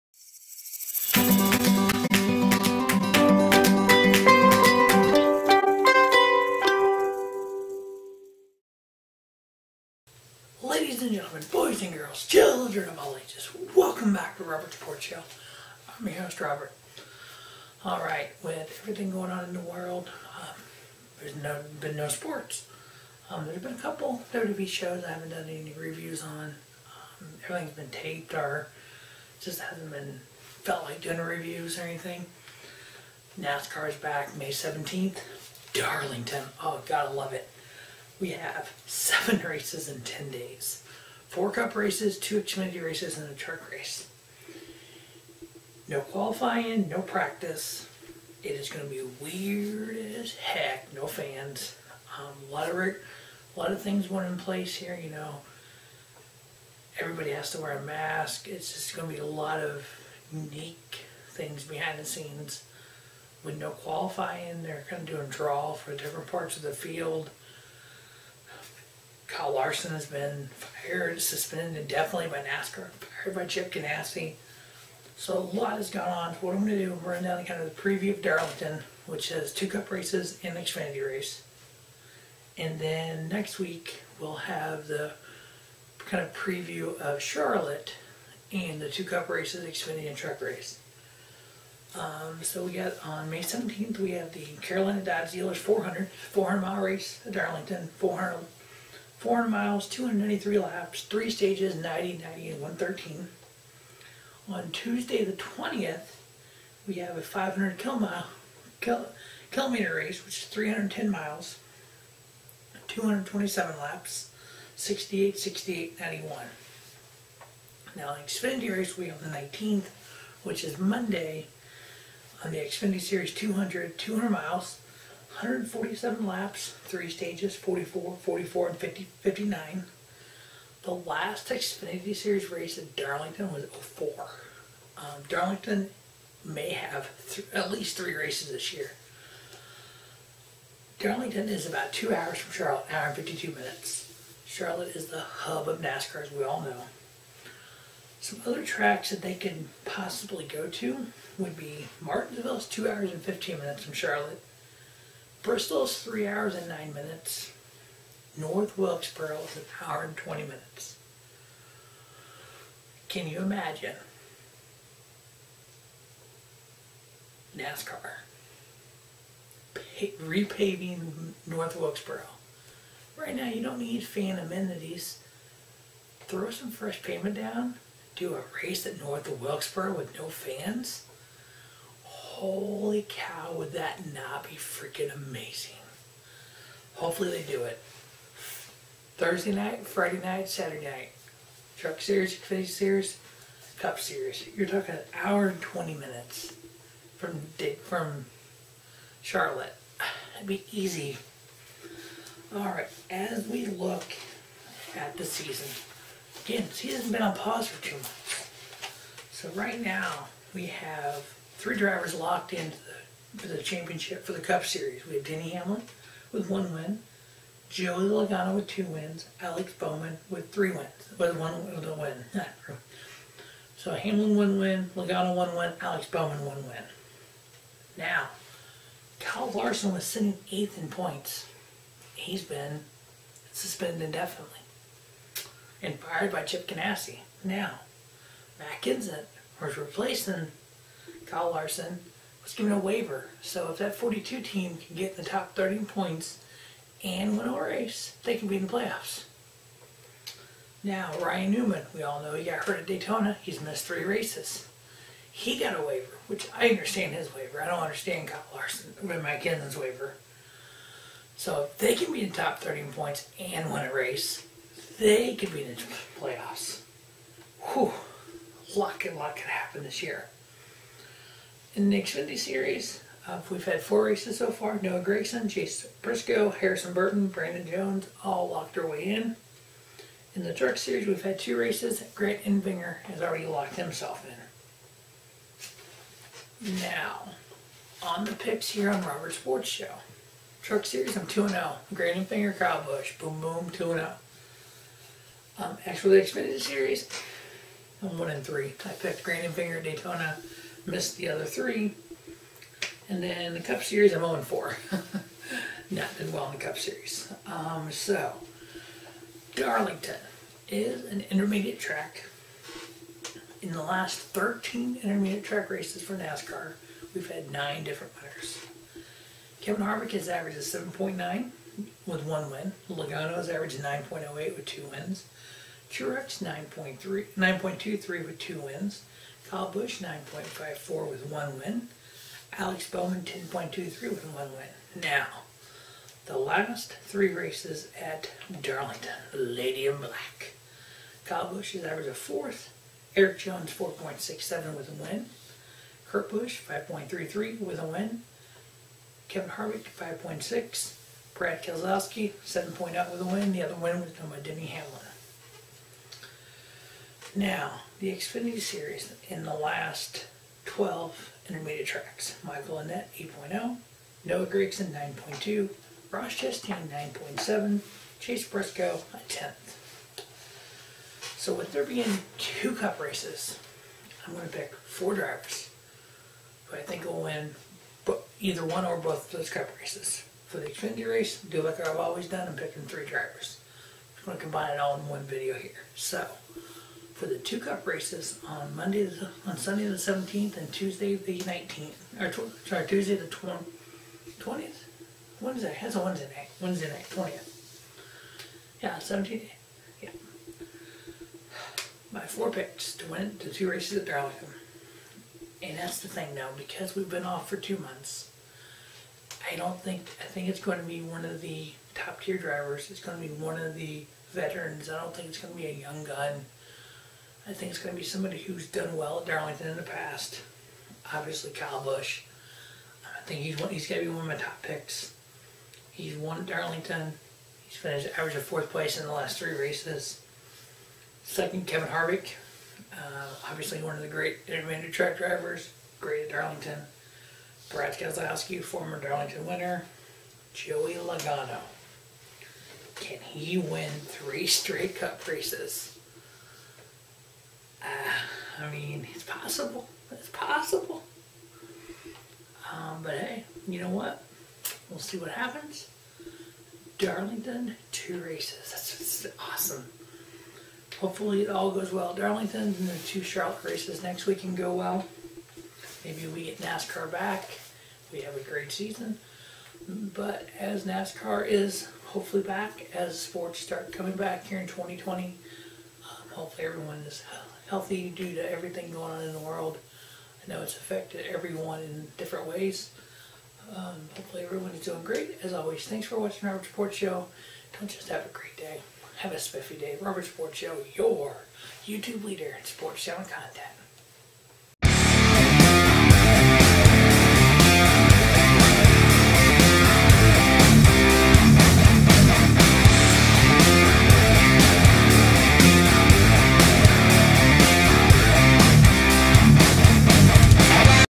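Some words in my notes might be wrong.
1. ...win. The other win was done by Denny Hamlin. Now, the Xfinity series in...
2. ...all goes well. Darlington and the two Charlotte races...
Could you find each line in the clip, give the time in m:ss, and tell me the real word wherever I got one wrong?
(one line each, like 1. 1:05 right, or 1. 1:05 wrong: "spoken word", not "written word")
1. 5:53 right
2. 7:41 right.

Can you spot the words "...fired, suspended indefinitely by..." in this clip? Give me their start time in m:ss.
1:10.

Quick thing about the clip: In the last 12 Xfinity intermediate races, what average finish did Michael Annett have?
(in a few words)
8.0.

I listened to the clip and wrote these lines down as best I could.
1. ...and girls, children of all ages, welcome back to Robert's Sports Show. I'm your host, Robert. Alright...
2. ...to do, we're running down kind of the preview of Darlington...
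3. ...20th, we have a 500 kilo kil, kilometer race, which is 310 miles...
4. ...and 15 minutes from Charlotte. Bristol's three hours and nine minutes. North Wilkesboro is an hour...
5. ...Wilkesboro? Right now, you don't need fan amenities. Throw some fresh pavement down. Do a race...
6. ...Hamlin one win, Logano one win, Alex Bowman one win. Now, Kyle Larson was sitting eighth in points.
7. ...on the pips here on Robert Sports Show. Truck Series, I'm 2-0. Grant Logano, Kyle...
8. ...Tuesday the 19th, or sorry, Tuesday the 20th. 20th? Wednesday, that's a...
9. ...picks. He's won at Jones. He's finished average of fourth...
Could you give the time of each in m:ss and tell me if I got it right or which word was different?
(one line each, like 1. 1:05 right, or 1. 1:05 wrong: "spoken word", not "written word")
1. 0:11 right
2. 1:16 right
3. 1:45 right
4. 2:33 right
5. 2:51 right
6. 3:43 right
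7. 4:48 wrong: "Enfinger", not "Logano"
8. 6:30 right
9. 7:04 wrong: "Darlington", not "Jones".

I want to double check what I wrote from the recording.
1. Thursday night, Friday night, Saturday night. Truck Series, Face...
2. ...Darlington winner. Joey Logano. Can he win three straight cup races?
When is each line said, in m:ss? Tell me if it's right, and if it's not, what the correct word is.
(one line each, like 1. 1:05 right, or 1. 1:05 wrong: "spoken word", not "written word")
1. 3:09 right
2. 7:18 right.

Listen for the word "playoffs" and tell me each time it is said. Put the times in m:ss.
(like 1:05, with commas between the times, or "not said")
4:08, 4:26.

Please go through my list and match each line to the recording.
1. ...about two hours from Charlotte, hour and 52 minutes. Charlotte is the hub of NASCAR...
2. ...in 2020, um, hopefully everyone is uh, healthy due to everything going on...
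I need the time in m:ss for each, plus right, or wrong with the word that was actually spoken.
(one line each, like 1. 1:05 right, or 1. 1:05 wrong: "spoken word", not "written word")
1. 2:21 right
2. 7:54 right.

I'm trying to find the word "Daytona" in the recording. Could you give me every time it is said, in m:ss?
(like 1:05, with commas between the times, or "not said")
4:12, 4:59.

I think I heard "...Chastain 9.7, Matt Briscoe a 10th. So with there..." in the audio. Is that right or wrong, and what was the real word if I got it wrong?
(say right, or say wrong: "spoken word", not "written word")
wrong: "Chase", not "Matt".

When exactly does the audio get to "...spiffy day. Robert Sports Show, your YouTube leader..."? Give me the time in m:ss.
8:09.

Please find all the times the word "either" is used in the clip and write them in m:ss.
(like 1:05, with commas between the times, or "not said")
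6:18.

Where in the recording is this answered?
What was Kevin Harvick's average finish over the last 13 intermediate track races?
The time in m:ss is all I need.
5:20.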